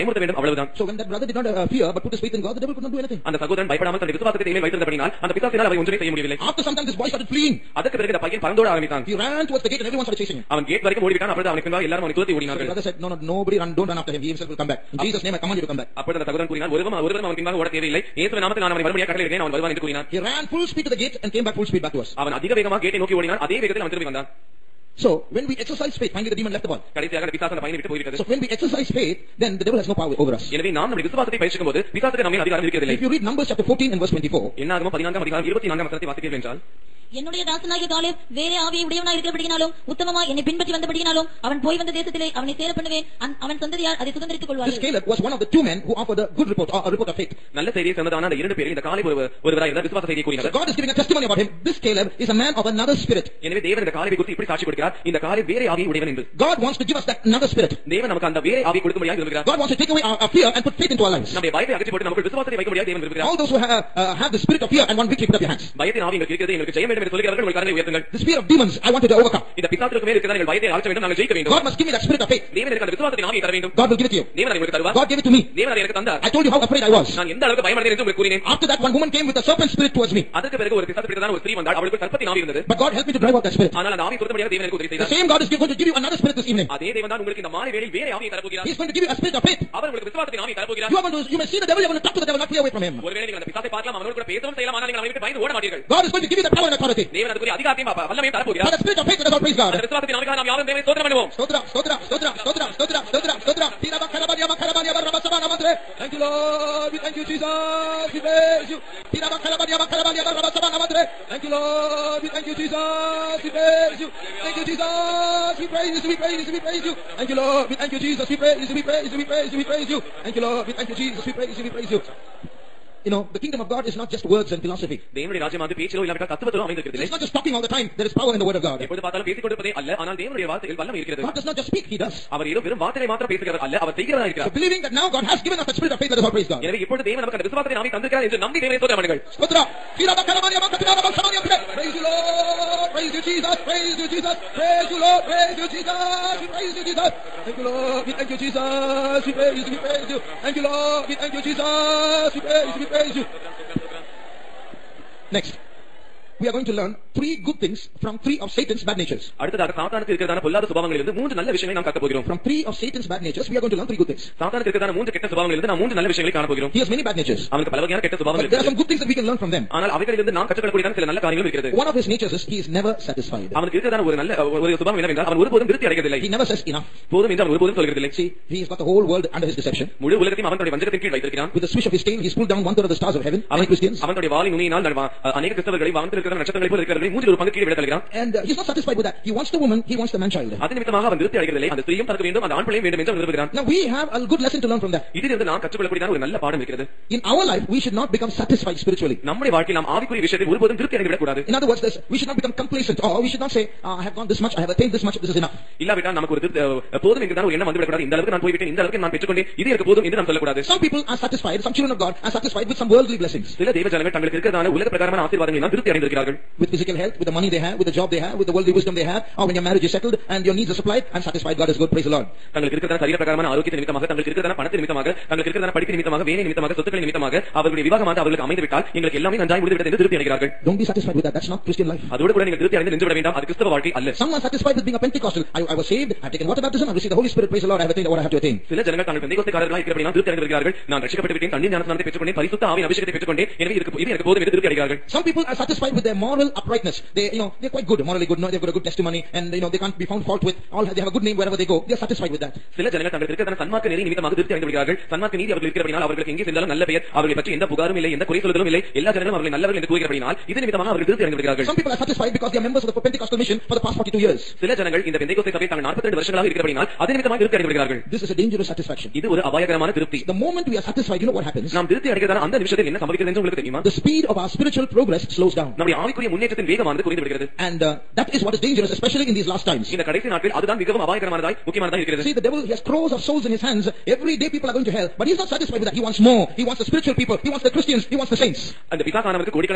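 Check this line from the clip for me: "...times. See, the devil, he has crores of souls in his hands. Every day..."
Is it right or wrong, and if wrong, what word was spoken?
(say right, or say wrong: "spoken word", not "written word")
right.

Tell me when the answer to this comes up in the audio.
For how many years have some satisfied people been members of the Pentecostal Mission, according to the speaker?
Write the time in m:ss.
4:23.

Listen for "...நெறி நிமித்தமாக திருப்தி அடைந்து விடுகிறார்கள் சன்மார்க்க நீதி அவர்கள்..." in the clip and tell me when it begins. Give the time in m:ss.
4:13.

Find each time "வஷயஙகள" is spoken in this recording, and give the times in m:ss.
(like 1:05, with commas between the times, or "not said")
2:41, 2:46.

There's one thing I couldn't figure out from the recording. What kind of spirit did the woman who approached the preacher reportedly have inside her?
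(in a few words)
Serpent spirit.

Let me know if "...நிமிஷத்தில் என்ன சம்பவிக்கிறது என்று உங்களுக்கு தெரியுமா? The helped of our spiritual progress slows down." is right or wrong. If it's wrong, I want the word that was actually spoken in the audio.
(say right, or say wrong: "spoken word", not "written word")
wrong: "speed", not "helped".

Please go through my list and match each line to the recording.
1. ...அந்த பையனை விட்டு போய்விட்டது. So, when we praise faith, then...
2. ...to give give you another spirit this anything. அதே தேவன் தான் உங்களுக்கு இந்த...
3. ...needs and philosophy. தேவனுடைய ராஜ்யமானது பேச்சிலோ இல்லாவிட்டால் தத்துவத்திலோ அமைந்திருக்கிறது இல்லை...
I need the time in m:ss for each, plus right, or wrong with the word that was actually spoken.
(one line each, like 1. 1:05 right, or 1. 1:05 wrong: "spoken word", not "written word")
1. 0:27 wrong: "exercise", not "praise"
2. 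1:25 wrong: "evening", not "anything"
3. 2:04 wrong: "words", not "needs".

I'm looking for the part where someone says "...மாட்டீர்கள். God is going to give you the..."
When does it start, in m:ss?
1:35.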